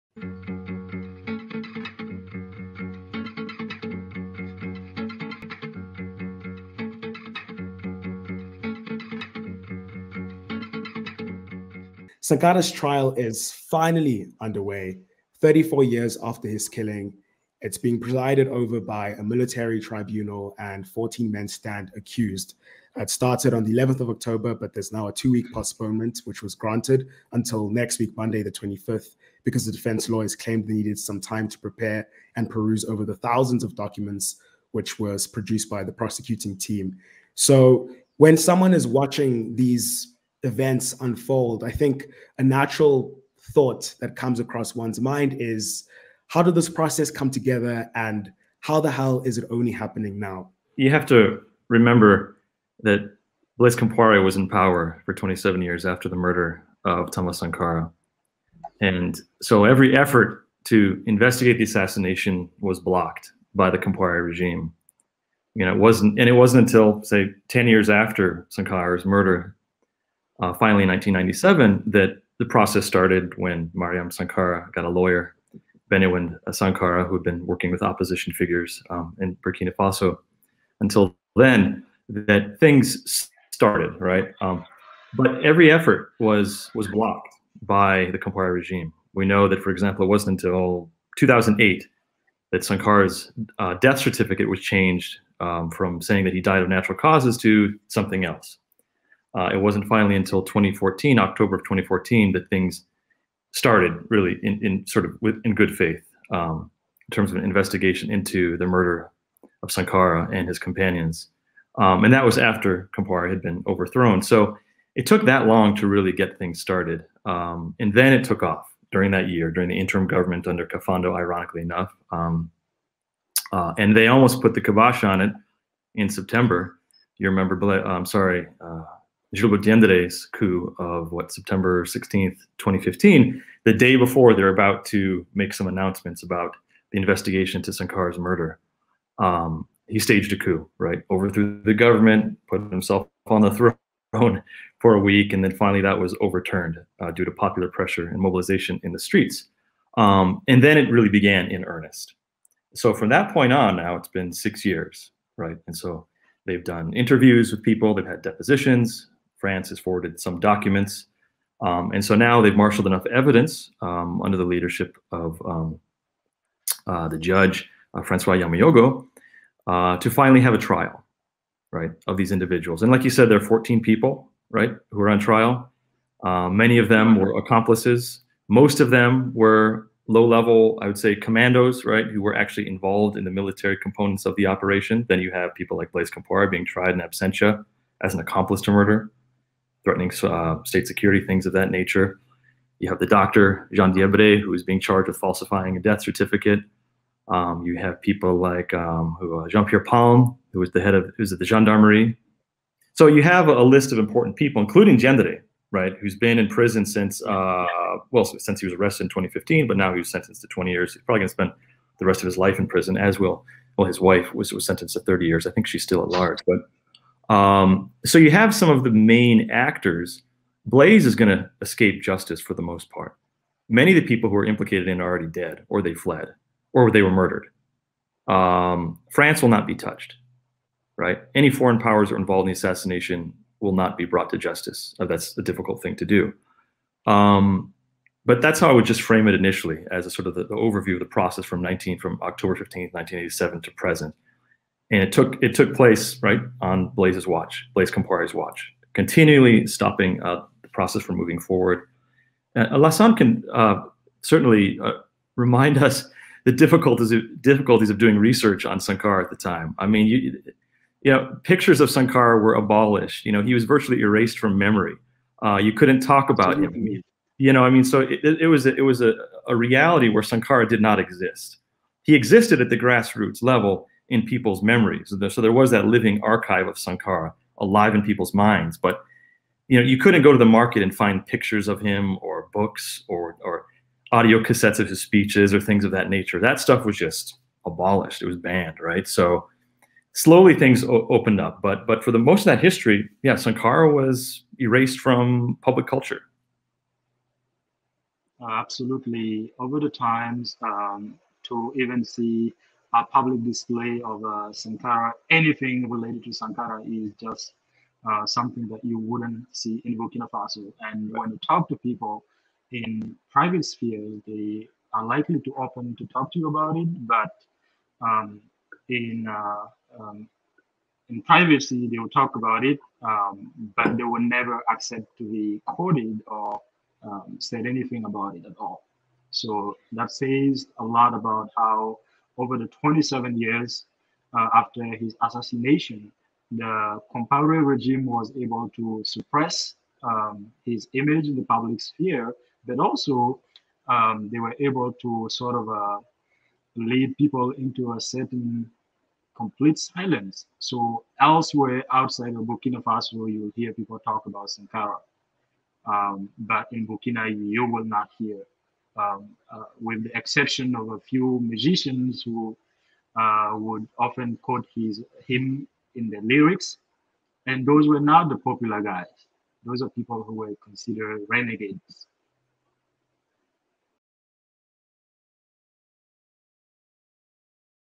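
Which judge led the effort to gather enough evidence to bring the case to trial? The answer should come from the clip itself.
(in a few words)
Francois Yaméogo.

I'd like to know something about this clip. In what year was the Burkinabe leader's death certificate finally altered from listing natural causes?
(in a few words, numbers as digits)
2008.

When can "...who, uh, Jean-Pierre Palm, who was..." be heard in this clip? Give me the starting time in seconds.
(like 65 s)
199 s.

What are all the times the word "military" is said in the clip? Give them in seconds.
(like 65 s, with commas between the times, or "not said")
19 s, 183 s.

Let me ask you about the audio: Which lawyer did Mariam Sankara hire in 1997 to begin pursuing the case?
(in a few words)
Bénéwendé Sankara.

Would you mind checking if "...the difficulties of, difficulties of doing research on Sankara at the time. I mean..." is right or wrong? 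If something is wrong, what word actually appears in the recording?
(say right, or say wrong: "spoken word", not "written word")
right.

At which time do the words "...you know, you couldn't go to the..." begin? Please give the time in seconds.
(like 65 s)
279 s.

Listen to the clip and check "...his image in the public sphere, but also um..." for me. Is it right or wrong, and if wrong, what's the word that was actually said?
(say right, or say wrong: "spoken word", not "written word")
right.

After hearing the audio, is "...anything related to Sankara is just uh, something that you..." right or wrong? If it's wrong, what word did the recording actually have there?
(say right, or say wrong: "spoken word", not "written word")
right.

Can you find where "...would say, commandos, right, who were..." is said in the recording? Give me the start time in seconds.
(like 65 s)
180 s.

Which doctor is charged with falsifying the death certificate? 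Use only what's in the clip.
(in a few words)
Jean Diébré.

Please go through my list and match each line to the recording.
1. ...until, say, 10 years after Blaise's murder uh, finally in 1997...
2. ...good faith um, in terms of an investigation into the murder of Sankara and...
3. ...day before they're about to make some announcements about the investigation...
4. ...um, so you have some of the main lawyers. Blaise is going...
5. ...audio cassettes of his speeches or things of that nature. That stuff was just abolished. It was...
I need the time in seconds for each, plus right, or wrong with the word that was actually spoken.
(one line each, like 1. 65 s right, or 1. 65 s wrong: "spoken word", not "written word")
1. 66 s wrong: "Sankara", not "Blaise"
2. 105 s right
3. 133 s right
4. 217 s wrong: "actors", not "lawyers"
5. 284 s right.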